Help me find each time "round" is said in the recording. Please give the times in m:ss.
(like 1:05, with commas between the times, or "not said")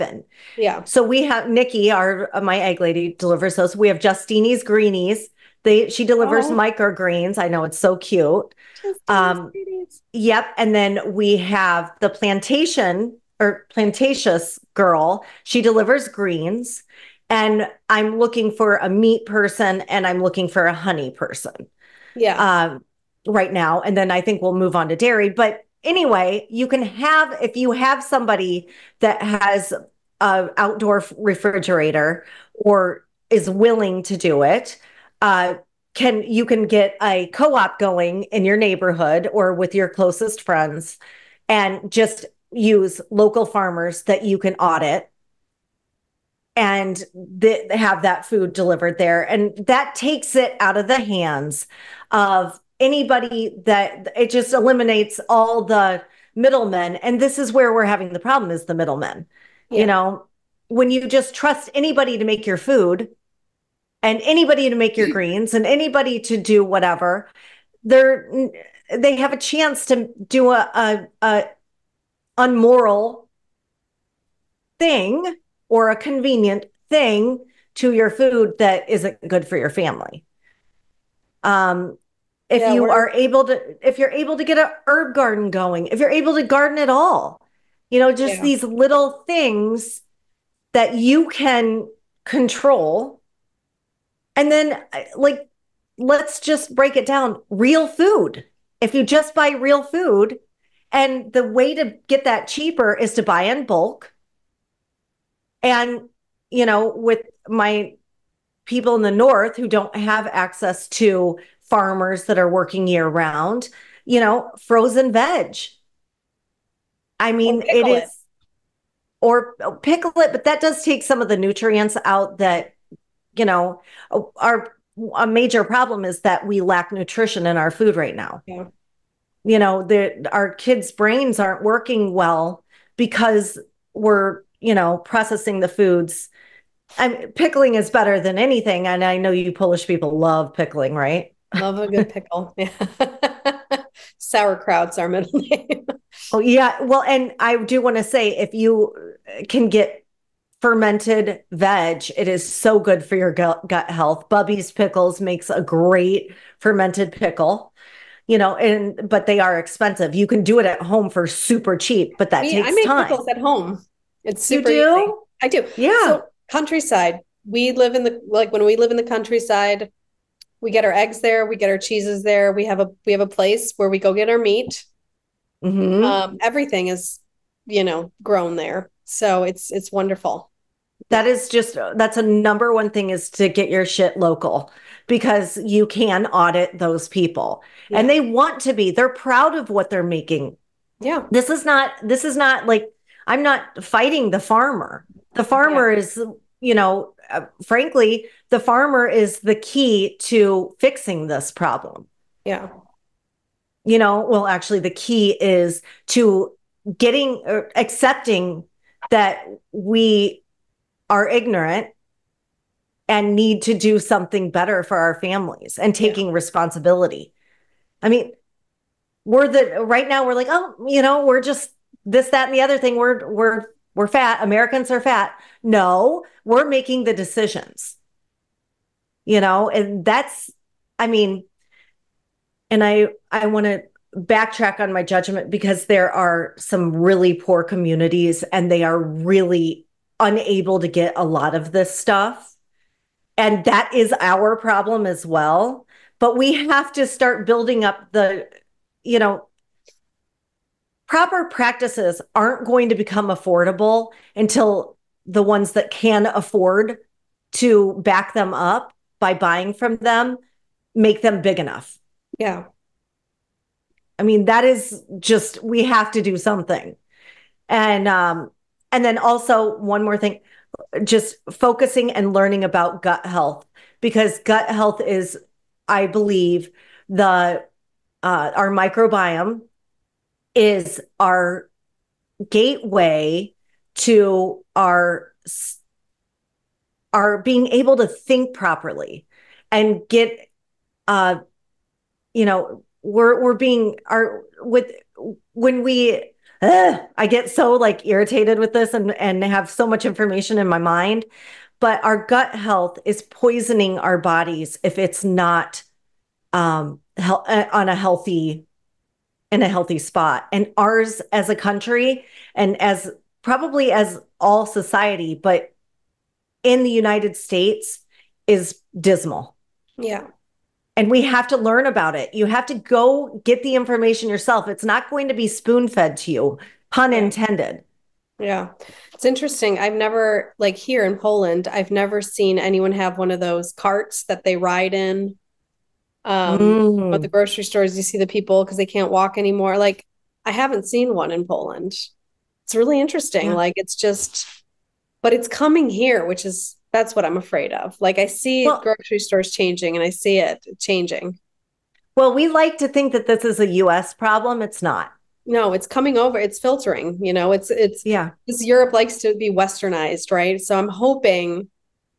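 1:53.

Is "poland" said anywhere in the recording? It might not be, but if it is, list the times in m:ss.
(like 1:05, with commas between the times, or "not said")
5:31, 5:41.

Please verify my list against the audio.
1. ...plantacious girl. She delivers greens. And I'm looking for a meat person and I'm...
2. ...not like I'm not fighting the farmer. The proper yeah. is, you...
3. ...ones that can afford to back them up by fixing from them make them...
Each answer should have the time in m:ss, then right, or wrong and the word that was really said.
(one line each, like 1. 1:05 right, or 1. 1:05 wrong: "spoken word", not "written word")
1. 0:13 right
2. 3:12 wrong: "farmer", not "proper"
3. 4:15 wrong: "buying", not "fixing".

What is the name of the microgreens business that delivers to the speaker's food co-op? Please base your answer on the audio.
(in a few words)
Justini's greenies.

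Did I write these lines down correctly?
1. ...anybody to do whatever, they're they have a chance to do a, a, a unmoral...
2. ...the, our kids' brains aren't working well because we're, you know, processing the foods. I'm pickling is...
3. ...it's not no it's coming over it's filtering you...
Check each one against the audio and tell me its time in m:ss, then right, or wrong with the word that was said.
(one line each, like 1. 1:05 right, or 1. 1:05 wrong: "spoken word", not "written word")
1. 1:05 right
2. 2:09 right
3. 5:54 right.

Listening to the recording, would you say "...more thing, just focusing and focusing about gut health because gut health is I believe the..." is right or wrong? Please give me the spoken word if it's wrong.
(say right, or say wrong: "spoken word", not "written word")
wrong: "learning", not "focusing".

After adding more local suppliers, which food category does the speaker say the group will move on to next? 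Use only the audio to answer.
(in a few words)
dairy.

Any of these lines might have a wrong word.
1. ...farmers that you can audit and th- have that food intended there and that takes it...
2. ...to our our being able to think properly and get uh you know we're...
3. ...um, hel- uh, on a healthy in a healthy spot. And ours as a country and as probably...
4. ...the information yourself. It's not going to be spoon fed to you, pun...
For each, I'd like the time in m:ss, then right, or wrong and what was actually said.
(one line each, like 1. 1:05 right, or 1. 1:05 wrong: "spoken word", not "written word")
1. 0:43 wrong: "delivered", not "intended"
2. 4:43 right
3. 5:06 right
4. 5:23 right.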